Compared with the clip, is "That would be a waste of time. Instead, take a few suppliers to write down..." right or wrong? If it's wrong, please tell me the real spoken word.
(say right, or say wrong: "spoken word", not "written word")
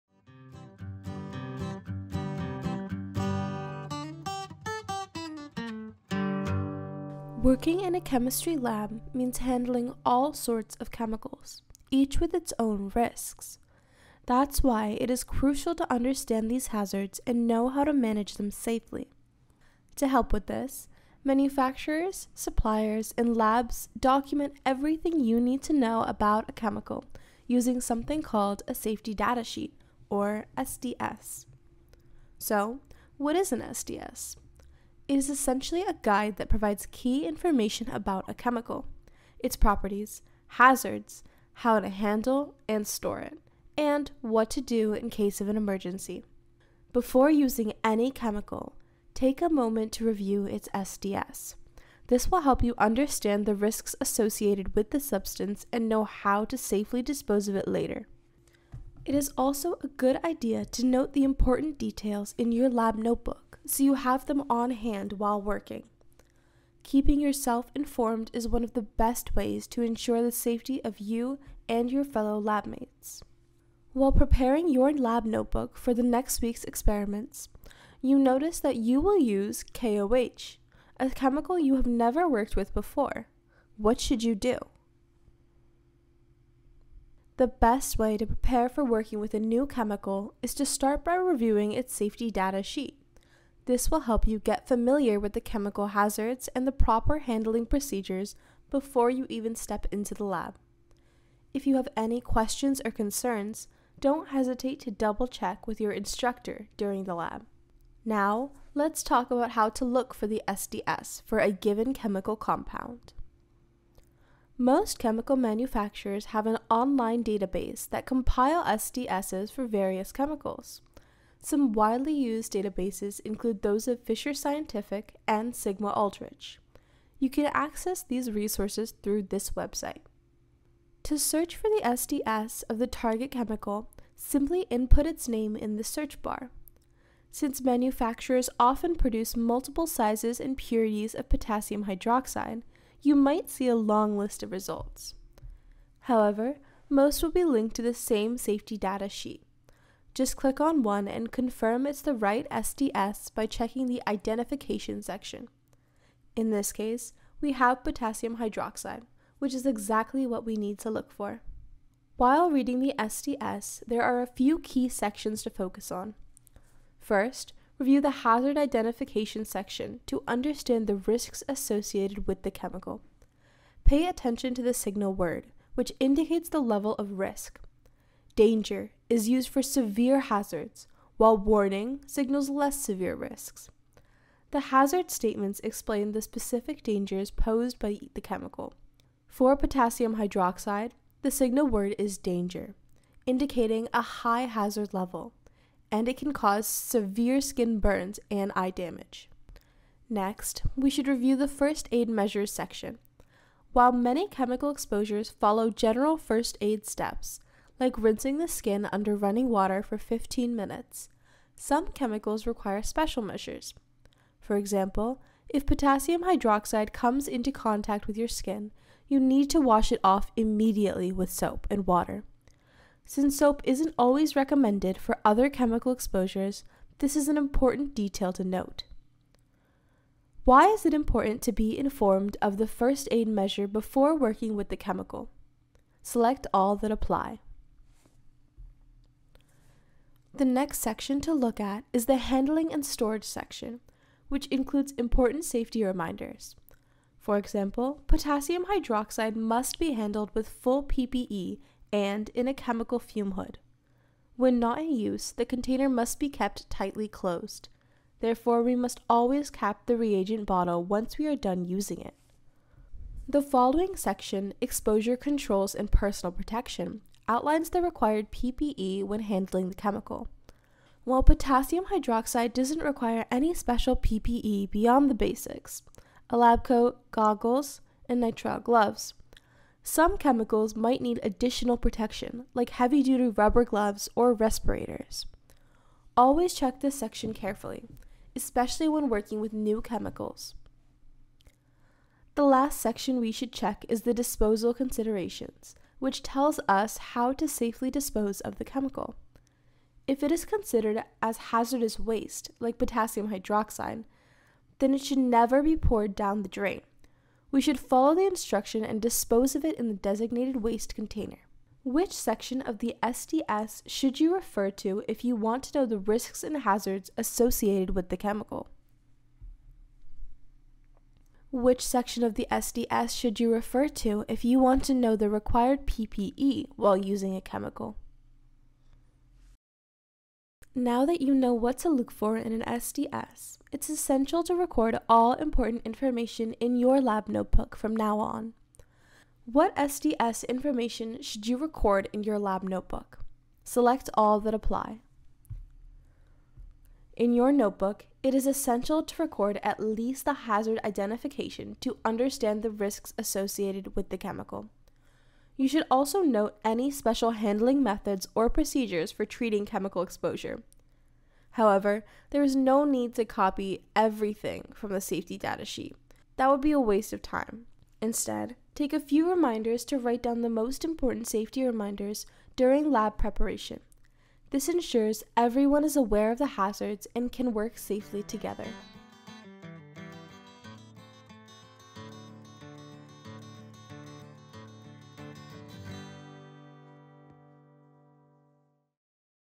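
wrong: "reminders", not "suppliers".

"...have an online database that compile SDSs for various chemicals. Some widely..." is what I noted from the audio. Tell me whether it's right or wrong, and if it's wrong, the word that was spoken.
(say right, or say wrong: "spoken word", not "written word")
right.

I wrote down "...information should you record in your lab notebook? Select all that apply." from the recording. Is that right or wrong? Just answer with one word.
right.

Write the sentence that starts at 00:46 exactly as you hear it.
Before using any chemical, take a moment to review its SDS.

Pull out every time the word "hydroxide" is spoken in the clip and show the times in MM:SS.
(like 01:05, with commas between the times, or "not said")
02:21, 02:38, 03:10, 03:36, 04:08, 04:31, 05:03.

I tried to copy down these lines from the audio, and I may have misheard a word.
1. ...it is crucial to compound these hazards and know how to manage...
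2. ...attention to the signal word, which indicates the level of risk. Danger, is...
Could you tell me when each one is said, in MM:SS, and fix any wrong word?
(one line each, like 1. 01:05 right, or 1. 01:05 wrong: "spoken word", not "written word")
1. 00:15 wrong: "understand", not "compound"
2. 02:54 right.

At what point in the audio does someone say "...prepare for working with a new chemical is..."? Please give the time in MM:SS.
01:28.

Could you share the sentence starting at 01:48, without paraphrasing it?
Now, let's talk about how to look for the SDS for a given chemical compound.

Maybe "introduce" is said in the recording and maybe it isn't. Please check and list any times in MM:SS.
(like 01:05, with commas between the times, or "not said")
not said.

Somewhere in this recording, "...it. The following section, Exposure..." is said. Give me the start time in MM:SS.
04:22.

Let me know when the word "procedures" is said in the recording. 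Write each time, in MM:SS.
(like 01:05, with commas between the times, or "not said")
01:37, 05:58.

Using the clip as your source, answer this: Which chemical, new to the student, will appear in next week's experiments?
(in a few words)
KOH.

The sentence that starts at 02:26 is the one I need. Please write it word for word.
However, most will be linked to the same safety data sheet.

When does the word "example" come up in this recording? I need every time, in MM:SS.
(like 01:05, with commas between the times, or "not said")
03:34, 04:07.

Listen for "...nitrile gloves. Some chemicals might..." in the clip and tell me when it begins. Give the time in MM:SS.
04:38.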